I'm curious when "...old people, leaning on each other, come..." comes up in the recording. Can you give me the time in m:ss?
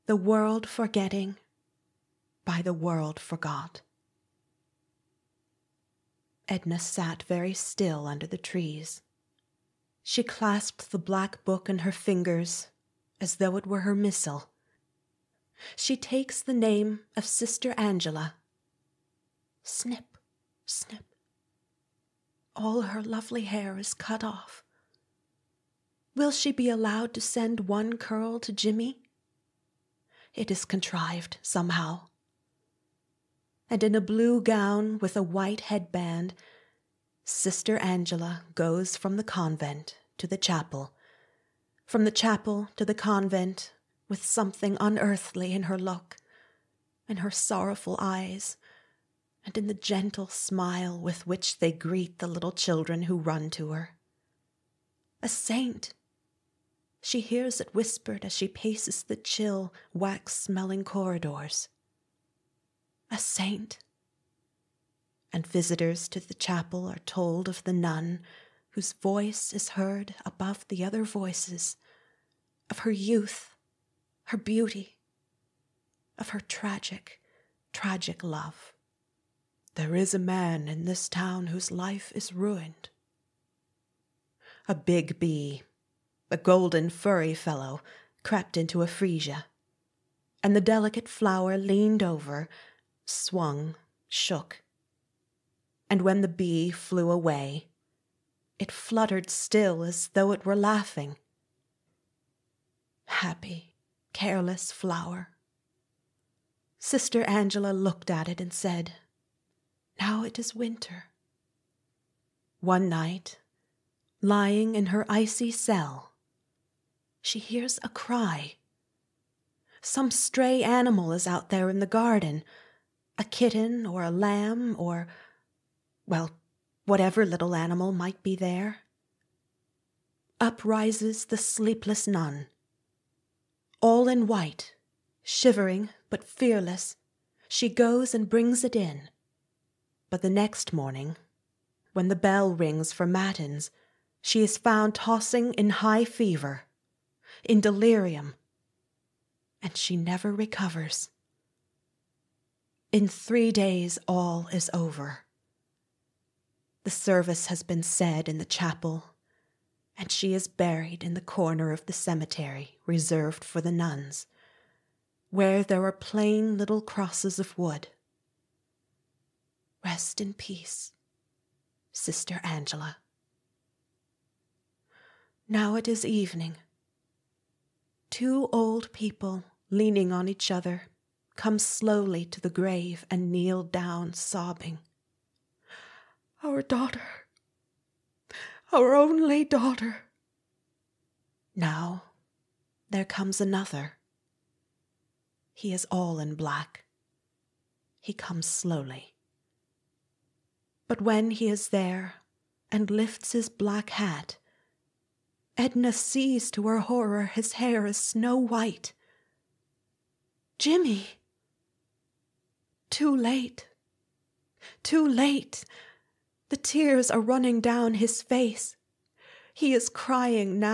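2:58.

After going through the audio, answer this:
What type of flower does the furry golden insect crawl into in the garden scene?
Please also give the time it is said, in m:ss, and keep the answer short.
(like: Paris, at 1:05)
Freesia, at 1:28.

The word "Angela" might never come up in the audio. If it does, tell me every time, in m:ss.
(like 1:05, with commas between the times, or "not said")
0:17, 0:37, 1:47, 2:52.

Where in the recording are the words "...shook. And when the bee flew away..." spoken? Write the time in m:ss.
1:34.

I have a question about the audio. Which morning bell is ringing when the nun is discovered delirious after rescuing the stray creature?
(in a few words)
Matins.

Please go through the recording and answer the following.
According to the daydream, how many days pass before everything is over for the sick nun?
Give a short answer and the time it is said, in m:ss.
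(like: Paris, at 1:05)
3, at 2:33.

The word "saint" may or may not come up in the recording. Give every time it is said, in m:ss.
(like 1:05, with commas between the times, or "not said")
0:55, 1:03.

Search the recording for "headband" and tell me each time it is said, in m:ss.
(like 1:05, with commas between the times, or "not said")
0:35.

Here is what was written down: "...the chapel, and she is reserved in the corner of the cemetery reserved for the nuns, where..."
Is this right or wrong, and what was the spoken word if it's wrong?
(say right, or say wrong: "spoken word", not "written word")
wrong: "buried", not "reserved".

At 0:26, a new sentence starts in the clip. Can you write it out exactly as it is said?
Will she be allowed to send one curl to Jimmy?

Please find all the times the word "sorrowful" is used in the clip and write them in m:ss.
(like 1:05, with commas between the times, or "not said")
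0:47.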